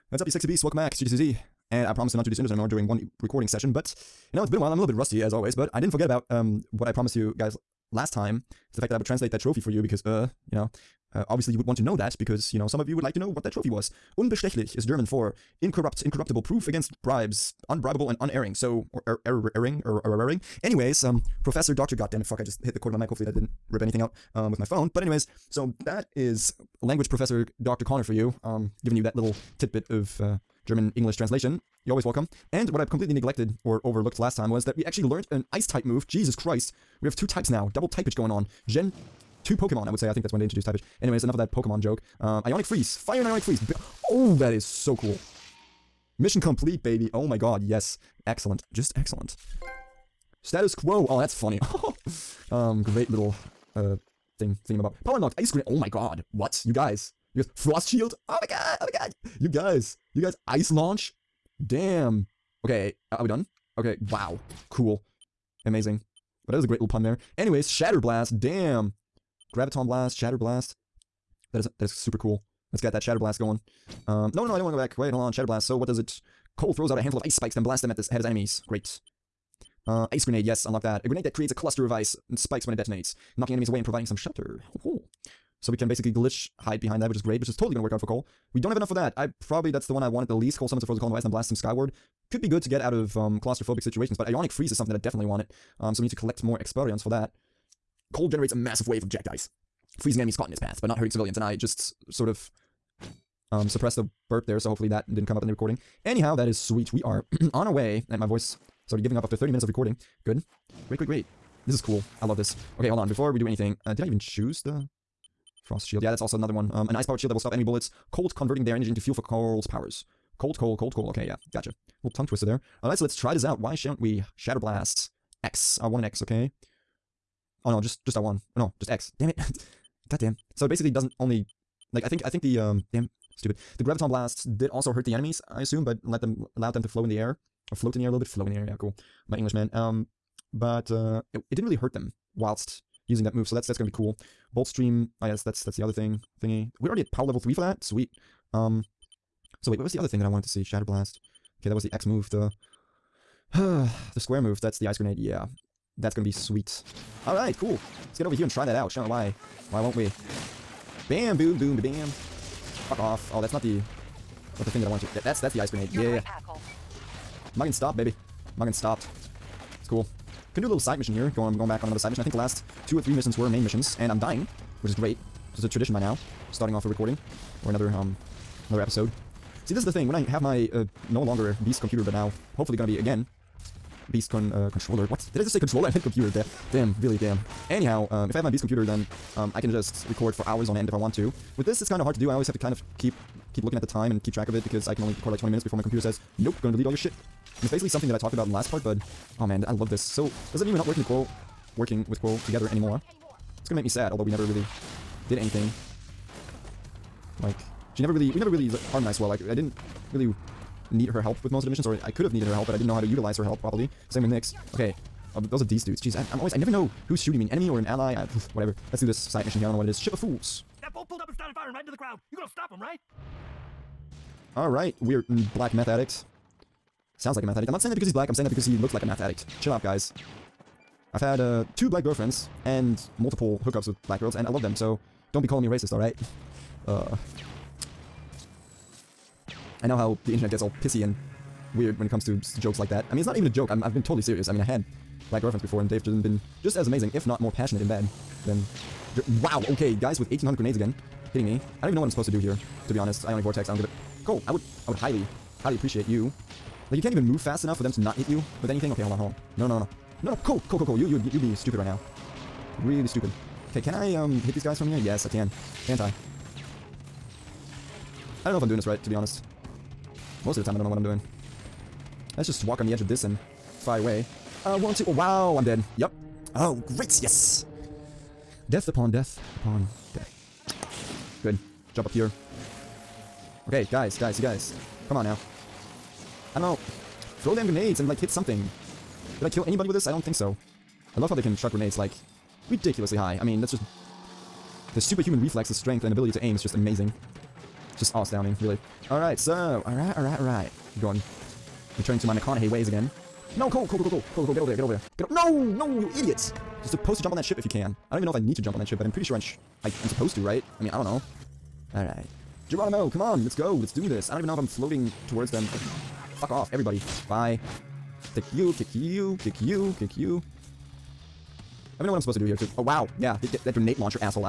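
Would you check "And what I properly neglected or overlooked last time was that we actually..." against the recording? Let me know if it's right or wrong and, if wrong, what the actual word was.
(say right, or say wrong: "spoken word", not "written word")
wrong: "completely", not "properly".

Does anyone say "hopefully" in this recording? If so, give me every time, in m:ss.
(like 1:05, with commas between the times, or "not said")
0:23, 1:44, 3:02.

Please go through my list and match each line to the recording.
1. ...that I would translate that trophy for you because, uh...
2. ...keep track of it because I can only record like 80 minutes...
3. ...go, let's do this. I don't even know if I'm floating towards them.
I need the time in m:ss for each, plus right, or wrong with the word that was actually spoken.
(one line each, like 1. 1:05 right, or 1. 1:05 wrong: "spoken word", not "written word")
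1. 0:08 right
2. 3:14 wrong: "20", not "80"
3. 5:13 right.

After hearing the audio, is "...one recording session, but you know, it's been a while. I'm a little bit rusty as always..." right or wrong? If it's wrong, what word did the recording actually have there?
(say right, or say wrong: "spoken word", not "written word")
right.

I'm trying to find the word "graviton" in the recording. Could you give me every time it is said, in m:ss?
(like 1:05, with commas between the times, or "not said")
1:09, 2:13.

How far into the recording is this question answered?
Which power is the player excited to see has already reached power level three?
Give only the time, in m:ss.
2:24.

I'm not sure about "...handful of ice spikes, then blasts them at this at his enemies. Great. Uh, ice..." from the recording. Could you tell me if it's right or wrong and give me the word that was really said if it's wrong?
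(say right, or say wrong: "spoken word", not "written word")
right.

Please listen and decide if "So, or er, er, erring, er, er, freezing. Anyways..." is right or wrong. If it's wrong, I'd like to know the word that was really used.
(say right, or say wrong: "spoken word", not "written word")
wrong: "erring", not "freezing".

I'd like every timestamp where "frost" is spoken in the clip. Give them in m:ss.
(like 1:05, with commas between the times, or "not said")
0:57, 1:55.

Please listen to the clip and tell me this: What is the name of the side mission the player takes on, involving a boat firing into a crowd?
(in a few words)
Ship of Fools.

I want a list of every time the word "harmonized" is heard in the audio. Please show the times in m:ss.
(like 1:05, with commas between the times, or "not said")
3:28.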